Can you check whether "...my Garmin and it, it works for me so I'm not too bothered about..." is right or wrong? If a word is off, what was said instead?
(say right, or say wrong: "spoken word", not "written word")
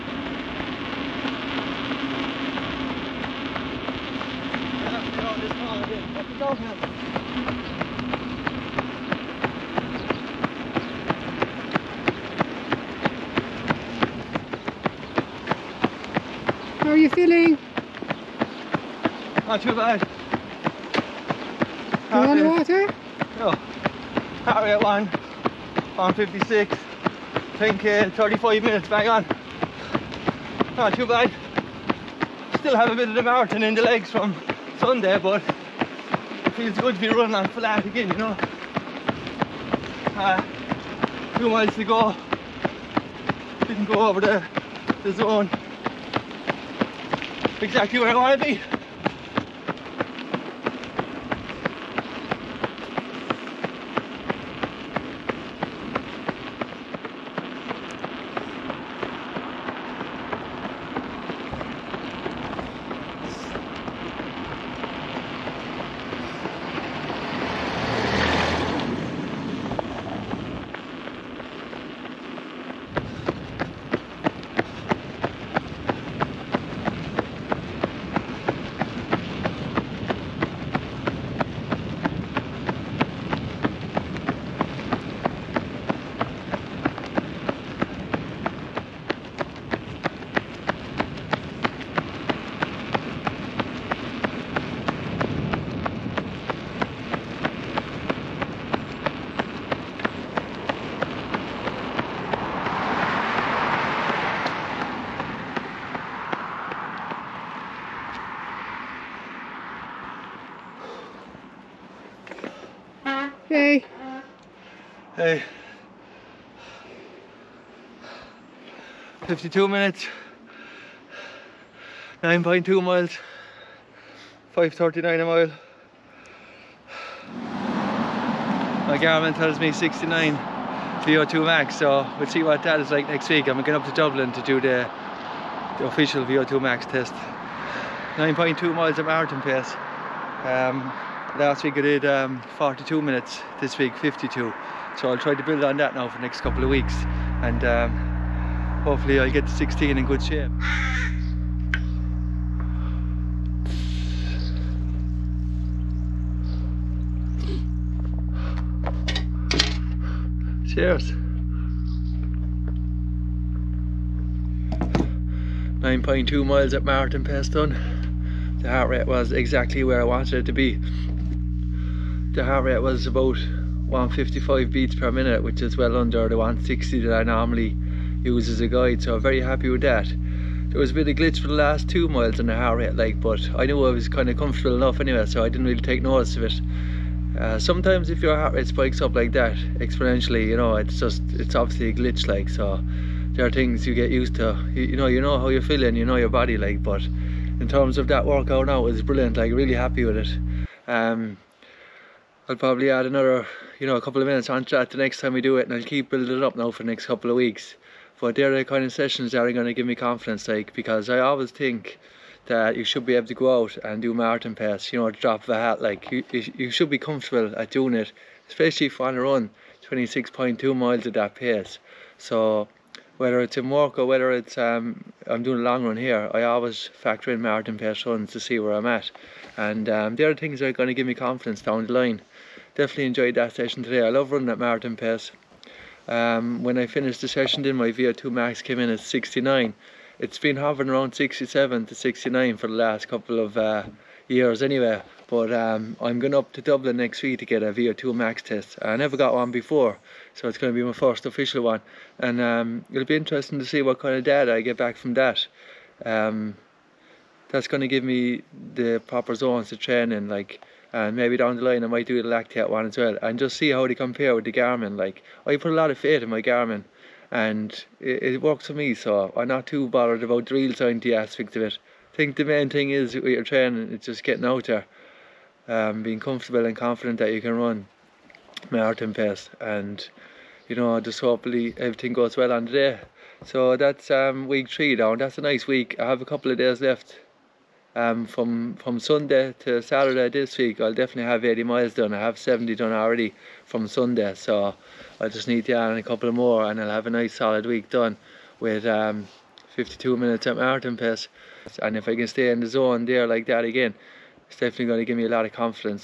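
right.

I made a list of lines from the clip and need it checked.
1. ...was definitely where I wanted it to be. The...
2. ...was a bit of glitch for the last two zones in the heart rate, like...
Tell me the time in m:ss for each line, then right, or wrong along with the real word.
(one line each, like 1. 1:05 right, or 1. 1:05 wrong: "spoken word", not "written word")
1. 2:49 wrong: "exactly", not "definitely"
2. 3:00 wrong: "miles", not "zones".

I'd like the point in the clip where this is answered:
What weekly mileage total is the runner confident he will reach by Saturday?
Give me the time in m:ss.
4:51.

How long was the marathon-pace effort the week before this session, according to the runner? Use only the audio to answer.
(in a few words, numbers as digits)
42 minutes.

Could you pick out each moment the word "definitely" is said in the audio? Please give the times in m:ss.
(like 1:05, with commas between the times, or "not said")
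3:52, 4:50, 5:04.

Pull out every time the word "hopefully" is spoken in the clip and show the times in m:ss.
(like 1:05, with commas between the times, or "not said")
2:28, 4:41.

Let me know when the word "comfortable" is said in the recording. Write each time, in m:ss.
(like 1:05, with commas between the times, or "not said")
3:04, 3:36, 4:36.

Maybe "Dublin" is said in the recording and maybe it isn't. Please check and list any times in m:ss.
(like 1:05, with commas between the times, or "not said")
2:13, 4:06.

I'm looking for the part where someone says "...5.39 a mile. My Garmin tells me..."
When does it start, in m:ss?
2:04.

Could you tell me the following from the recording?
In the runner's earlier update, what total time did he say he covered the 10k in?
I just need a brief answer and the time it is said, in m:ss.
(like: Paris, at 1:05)
35 minutes, at 0:28.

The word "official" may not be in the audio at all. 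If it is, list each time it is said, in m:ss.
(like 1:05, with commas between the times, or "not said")
2:15, 4:11.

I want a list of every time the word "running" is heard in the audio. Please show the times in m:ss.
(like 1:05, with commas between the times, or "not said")
0:37, 3:54.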